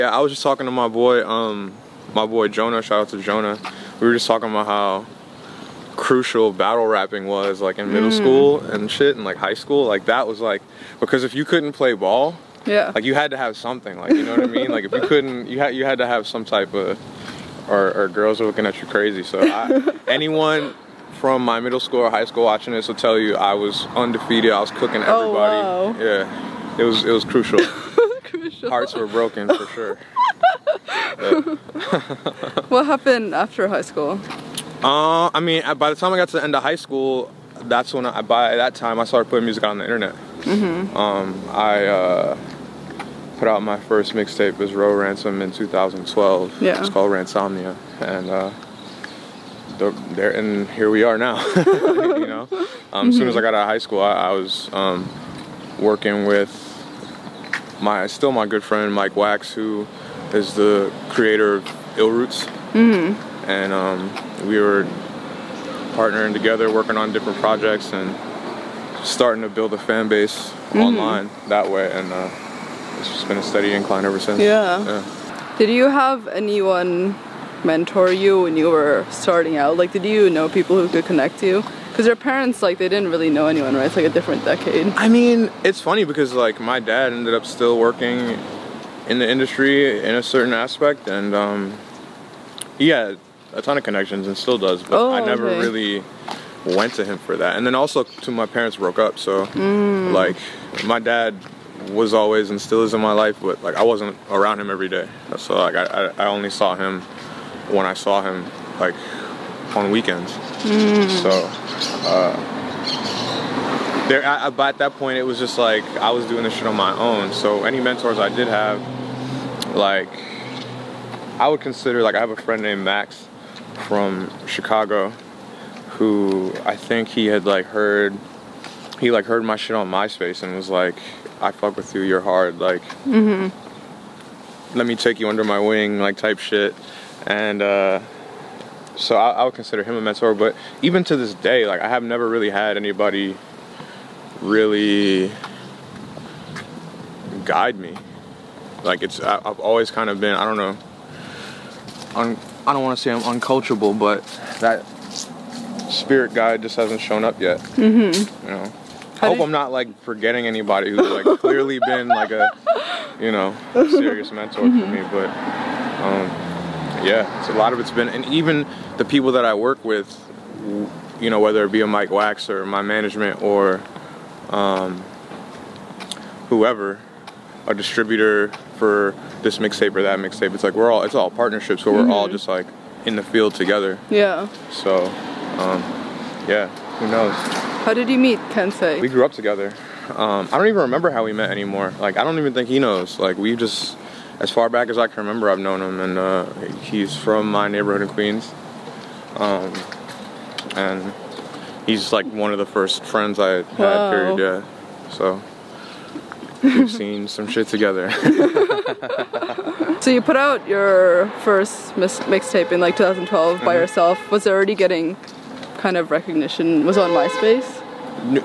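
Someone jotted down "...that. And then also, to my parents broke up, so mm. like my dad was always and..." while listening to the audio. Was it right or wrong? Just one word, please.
right.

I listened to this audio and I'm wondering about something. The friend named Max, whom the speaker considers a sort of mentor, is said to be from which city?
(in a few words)
Chicago.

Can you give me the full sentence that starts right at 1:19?
Like, did you know people who could connect you?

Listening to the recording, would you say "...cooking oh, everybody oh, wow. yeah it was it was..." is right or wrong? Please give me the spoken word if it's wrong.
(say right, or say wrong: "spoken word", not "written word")
right.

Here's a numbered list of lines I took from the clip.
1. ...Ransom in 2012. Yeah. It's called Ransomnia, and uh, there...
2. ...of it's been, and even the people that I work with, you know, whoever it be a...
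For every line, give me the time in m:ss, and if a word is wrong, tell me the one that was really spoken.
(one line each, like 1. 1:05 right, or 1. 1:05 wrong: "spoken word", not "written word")
1. 0:44 right
2. 2:47 wrong: "whether", not "whoever".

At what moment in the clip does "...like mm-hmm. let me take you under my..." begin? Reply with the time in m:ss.
2:12.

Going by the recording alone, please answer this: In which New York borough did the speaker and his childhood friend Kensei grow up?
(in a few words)
Queens.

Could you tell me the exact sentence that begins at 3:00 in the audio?
It's like we're all it's all partnerships where mm-hmm.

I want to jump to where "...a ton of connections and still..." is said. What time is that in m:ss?
1:33.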